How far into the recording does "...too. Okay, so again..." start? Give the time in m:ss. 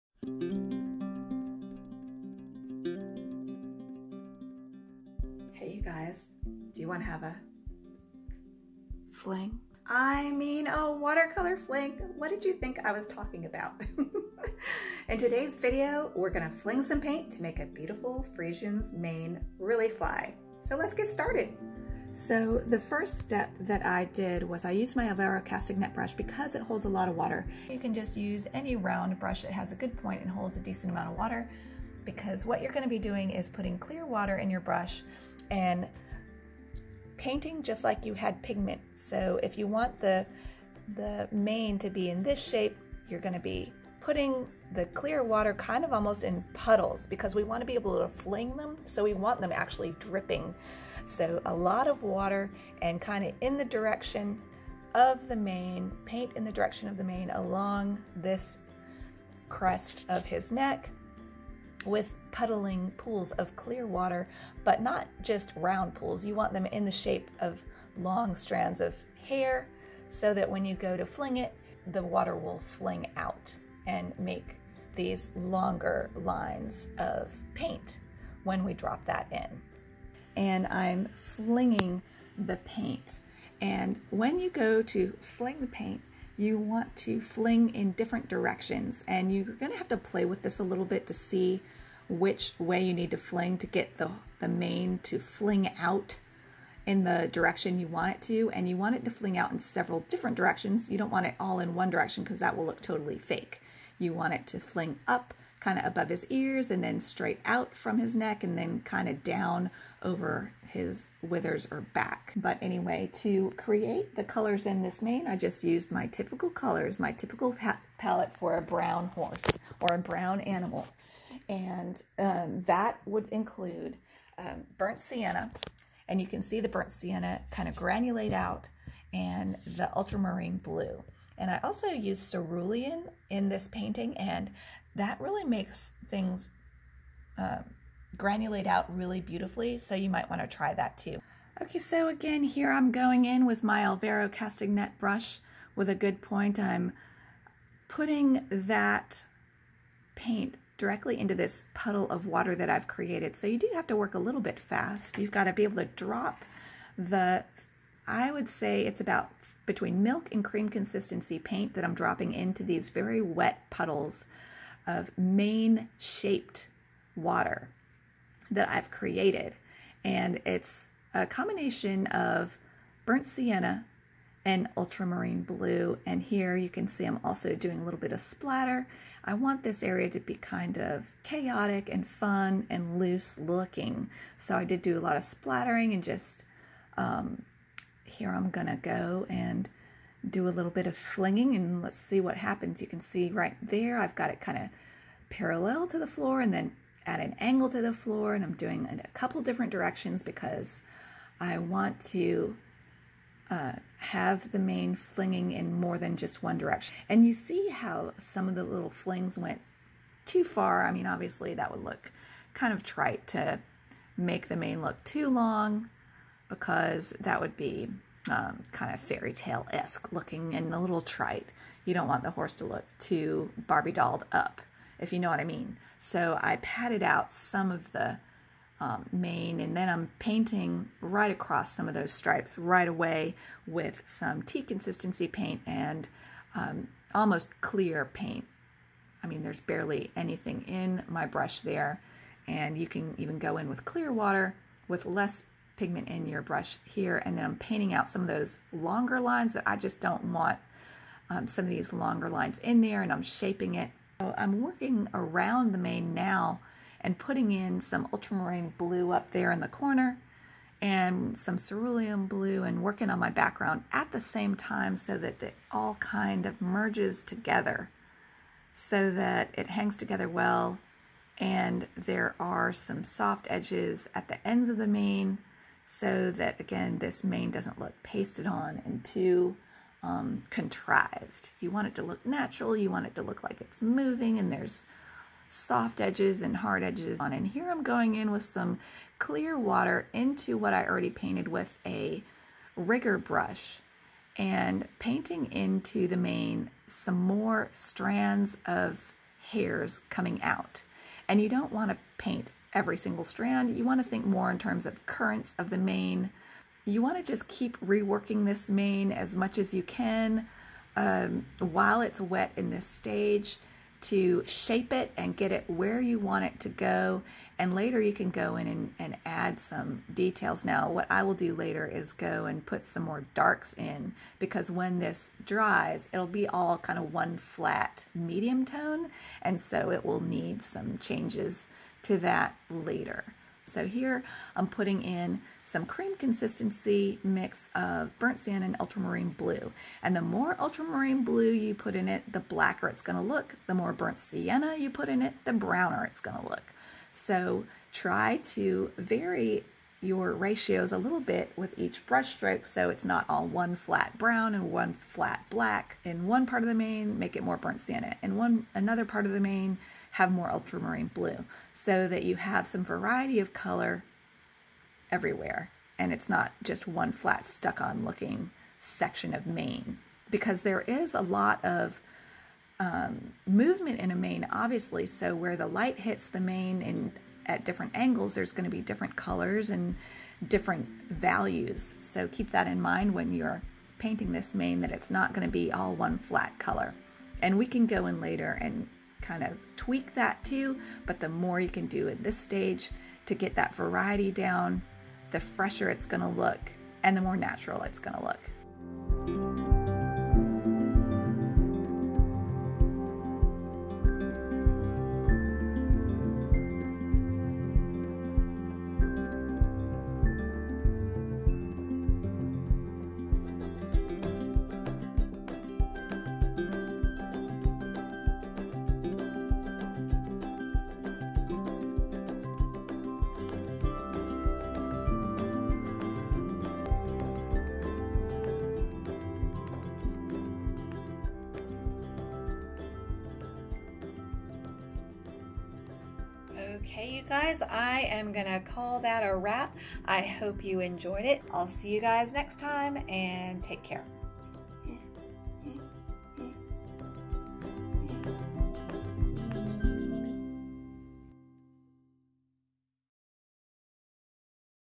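2:20.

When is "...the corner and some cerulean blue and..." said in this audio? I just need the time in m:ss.
4:19.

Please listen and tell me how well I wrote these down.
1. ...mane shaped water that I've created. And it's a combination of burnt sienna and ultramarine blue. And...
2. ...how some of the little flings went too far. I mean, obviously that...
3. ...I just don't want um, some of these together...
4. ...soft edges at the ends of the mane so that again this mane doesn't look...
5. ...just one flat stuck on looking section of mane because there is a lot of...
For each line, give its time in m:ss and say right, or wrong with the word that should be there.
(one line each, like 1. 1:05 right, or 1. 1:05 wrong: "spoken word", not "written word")
1. 2:45 right
2. 3:27 right
3. 4:09 wrong: "longer", not "together"
4. 4:33 right
5. 6:06 right.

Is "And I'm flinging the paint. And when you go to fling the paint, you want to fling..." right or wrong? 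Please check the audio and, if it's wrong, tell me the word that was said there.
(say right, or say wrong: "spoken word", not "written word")
right.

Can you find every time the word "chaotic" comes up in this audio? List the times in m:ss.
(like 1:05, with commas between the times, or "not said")
3:01.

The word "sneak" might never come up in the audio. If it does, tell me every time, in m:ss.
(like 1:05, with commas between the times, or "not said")
not said.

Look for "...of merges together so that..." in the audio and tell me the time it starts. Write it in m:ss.
4:26.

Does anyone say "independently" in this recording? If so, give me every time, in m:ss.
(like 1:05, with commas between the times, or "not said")
not said.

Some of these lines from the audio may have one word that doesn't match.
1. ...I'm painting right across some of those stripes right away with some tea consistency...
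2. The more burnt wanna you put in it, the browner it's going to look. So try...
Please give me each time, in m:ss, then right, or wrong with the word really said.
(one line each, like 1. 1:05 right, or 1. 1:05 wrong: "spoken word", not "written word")
1. 3:49 right
2. 5:43 wrong: "sienna", not "wanna".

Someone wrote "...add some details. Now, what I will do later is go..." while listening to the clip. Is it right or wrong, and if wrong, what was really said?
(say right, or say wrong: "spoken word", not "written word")
right.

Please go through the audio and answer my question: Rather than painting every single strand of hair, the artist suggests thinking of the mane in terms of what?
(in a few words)
Currents.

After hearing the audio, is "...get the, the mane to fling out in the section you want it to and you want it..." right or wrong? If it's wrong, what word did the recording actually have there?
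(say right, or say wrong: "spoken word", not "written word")
wrong: "direction", not "section".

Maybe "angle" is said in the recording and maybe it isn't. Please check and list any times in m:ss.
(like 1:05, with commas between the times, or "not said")
3:17, 6:17.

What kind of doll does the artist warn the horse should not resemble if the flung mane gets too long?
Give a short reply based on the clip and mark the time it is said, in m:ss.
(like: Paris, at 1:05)
Barbie, at 3:43.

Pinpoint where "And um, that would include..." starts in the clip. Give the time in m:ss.
2:01.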